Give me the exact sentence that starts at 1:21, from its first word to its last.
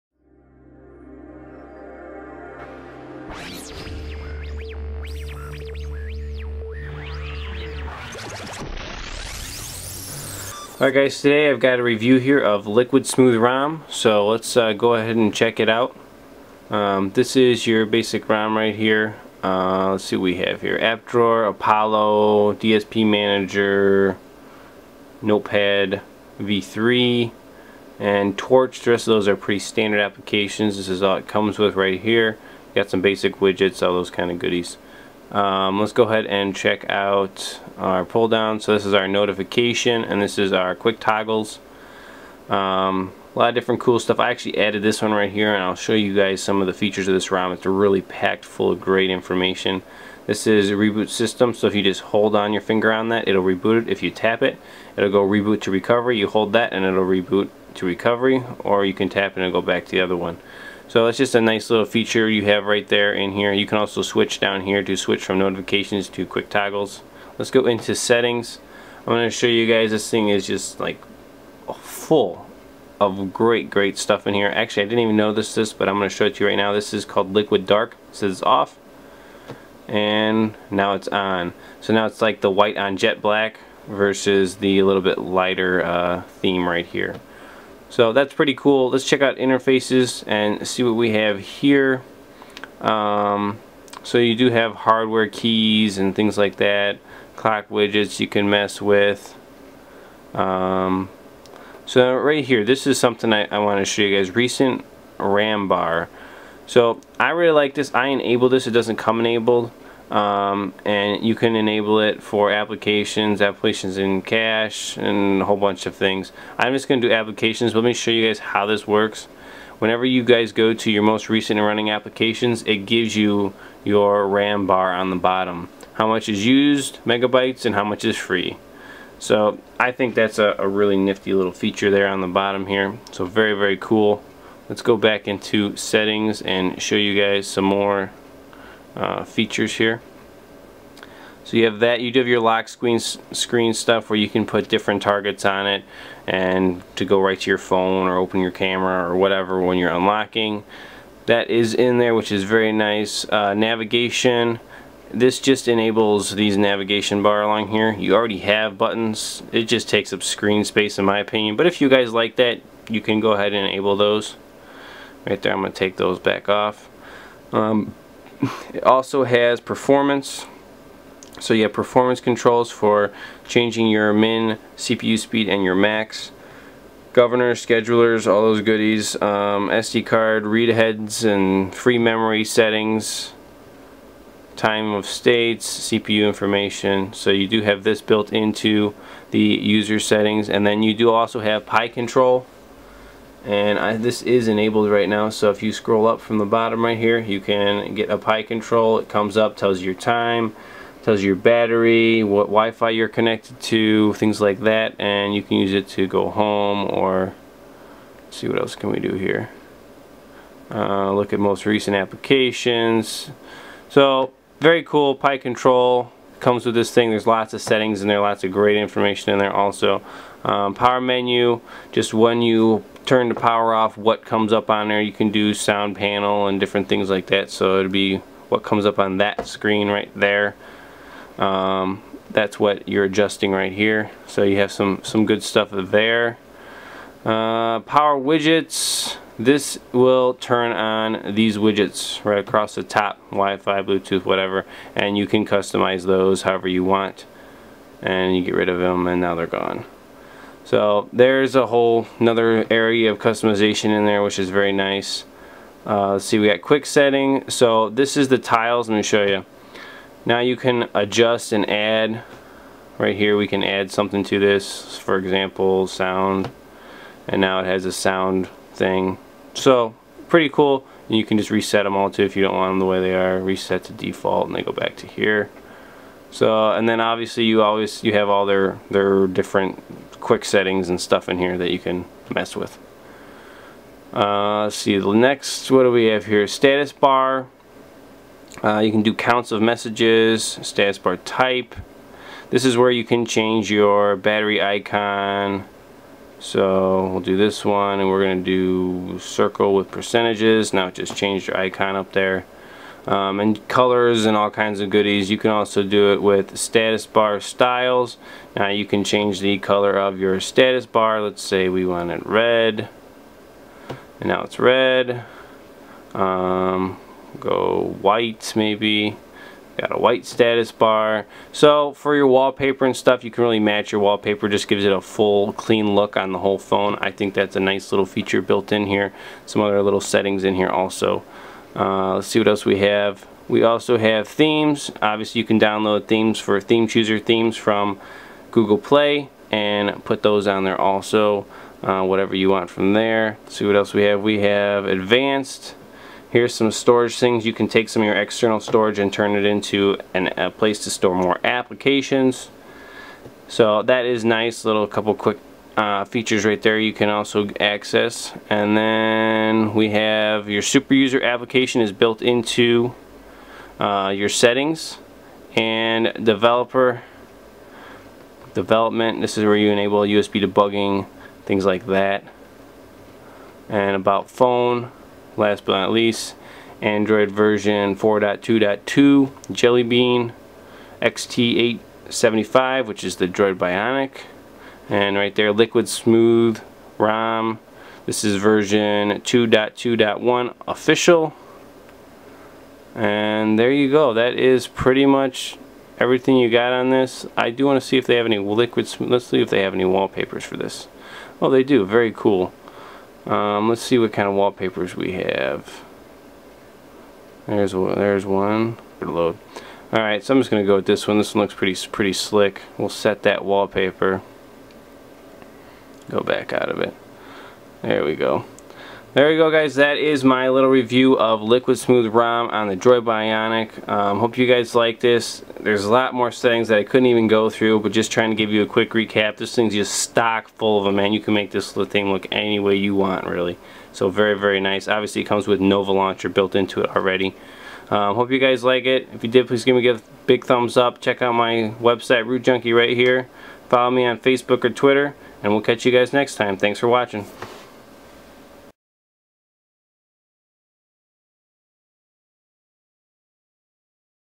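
So now it's like the white on jet black versus the little bit lighter uh, theme right here.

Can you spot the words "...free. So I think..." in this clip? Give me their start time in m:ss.
2:08.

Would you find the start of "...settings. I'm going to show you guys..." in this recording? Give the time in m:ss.
1:07.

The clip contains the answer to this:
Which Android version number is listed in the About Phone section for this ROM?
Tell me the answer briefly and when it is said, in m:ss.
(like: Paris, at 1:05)
4.2.2, at 6:17.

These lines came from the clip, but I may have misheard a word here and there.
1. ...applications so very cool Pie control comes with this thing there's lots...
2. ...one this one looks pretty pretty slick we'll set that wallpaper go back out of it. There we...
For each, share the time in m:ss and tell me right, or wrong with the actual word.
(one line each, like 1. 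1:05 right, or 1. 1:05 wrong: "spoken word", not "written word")
1. 3:31 right
2. 6:51 right.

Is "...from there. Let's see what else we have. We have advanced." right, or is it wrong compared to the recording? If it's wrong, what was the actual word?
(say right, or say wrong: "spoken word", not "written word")
right.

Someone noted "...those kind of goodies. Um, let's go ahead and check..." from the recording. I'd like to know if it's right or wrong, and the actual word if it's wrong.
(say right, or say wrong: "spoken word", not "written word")
right.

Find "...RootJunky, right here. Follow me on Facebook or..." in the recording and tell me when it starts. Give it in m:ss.
7:22.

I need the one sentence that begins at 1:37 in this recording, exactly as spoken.
Clock widgets you can mess with.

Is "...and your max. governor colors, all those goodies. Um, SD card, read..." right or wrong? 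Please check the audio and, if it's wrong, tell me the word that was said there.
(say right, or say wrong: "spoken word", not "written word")
wrong: "schedulers", not "colors".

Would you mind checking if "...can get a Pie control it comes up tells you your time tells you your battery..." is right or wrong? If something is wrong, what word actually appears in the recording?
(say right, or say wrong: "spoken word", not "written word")
right.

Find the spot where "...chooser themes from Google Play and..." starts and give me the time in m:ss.
5:36.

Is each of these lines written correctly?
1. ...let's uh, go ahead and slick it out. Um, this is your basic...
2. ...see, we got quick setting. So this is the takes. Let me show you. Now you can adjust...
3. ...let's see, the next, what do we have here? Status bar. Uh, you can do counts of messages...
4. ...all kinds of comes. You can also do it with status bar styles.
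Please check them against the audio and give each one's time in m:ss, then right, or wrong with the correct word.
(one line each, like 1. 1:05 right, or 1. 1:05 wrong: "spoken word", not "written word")
1. 0:14 wrong: "check", not "slick"
2. 4:16 wrong: "tiles", not "takes"
3. 4:44 right
4. 5:04 wrong: "goodies", not "comes".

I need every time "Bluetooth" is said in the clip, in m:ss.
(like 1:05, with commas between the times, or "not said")
4:03.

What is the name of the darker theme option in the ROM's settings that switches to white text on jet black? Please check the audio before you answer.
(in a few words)
Liquid Dark.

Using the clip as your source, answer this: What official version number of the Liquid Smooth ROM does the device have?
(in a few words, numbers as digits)
2.2.1.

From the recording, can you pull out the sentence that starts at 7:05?
There's a lot more settings that I couldn't even go through, but just trying to give you a quick recap.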